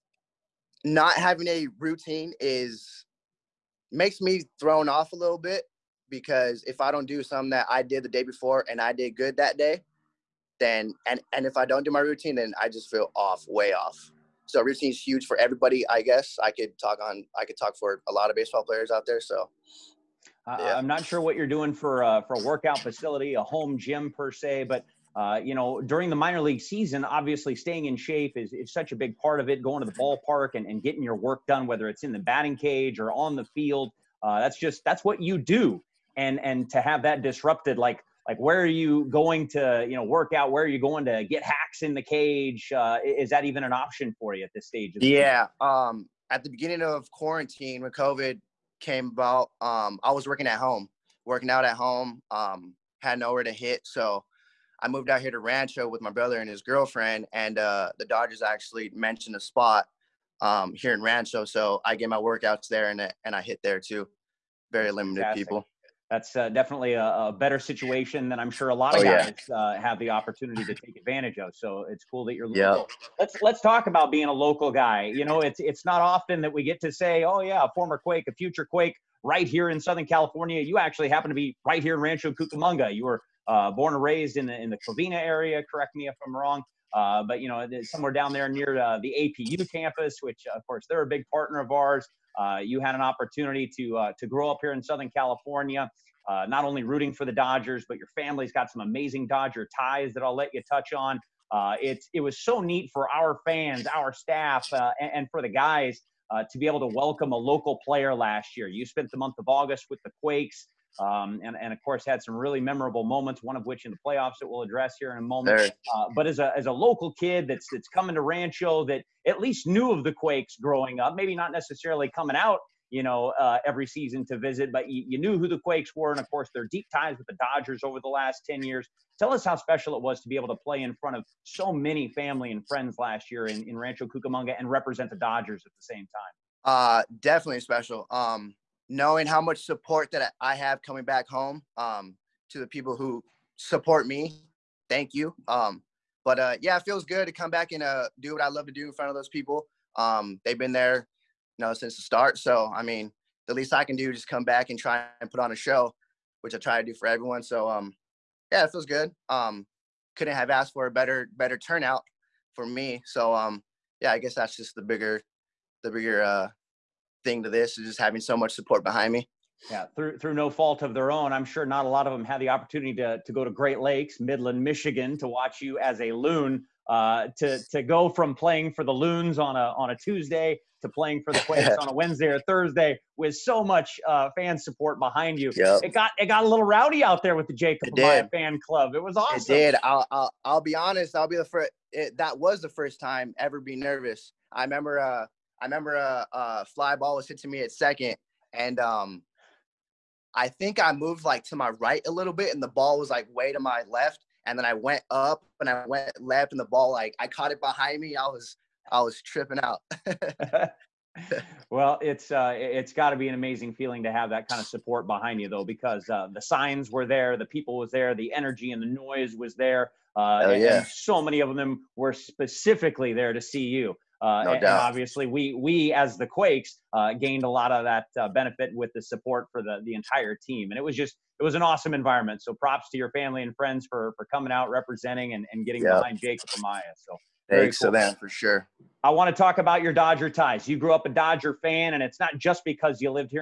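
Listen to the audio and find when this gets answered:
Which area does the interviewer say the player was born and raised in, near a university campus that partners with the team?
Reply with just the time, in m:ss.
1:24.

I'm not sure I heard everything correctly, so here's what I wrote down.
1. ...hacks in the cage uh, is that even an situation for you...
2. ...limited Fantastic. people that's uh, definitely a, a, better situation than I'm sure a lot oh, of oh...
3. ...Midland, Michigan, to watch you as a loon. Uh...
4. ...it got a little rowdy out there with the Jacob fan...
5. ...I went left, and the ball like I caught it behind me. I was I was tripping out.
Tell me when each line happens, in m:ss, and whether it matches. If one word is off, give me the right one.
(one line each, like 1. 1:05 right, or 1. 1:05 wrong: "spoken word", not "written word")
1. 0:41 wrong: "option", not "situation"
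2. 1:04 right
3. 2:54 right
4. 3:06 right
5. 3:25 right.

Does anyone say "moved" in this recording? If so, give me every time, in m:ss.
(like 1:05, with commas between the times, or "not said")
0:54, 3:20.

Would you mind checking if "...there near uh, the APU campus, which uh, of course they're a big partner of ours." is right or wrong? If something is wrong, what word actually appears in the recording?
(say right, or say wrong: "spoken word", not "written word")
right.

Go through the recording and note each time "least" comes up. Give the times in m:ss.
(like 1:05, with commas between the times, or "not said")
1:59, 2:33.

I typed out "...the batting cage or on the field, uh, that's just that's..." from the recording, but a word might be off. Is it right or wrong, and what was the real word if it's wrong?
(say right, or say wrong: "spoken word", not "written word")
right.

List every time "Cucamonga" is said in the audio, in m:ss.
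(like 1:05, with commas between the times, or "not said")
1:22, 2:14.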